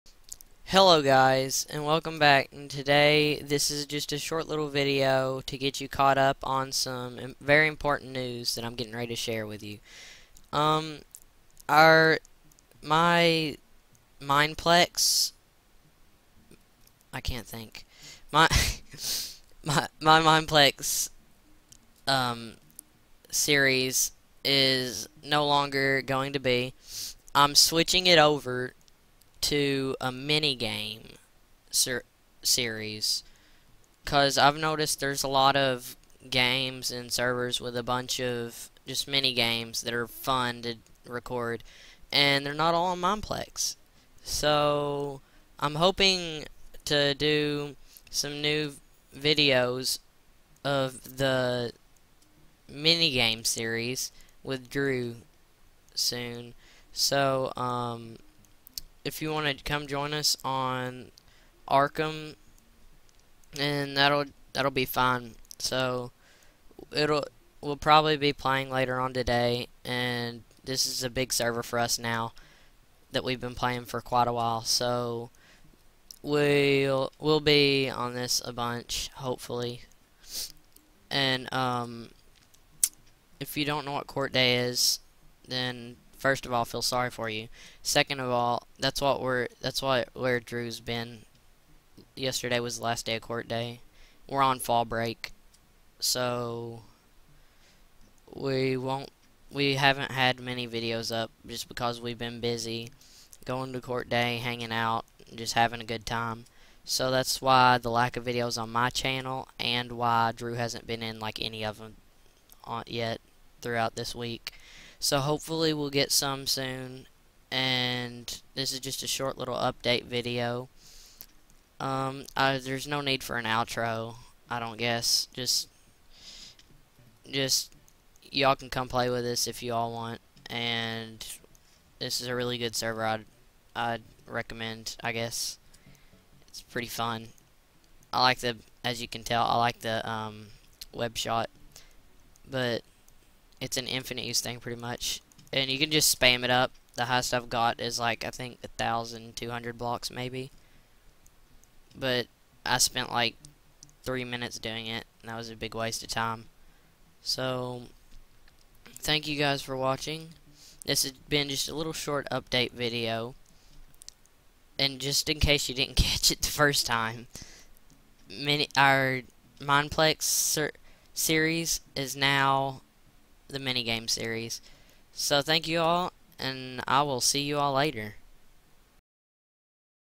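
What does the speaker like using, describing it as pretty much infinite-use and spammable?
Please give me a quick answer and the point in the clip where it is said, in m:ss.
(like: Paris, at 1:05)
Web shot, at 2:20.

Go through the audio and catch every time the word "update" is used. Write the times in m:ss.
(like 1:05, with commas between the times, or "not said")
1:59, 2:42.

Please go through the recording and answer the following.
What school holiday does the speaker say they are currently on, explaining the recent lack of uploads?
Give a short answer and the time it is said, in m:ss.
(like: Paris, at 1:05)
Fall break, at 1:34.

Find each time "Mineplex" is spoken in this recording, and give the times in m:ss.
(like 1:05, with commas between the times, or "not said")
0:14, 0:20, 0:43, 2:49.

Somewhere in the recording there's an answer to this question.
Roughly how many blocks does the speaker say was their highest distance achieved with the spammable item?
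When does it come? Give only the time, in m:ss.
2:28.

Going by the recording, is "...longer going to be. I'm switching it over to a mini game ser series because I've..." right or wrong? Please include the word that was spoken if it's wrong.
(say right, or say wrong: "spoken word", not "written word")
right.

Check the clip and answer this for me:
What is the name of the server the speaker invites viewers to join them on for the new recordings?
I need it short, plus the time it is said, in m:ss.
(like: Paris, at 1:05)
Arkham, at 1:01.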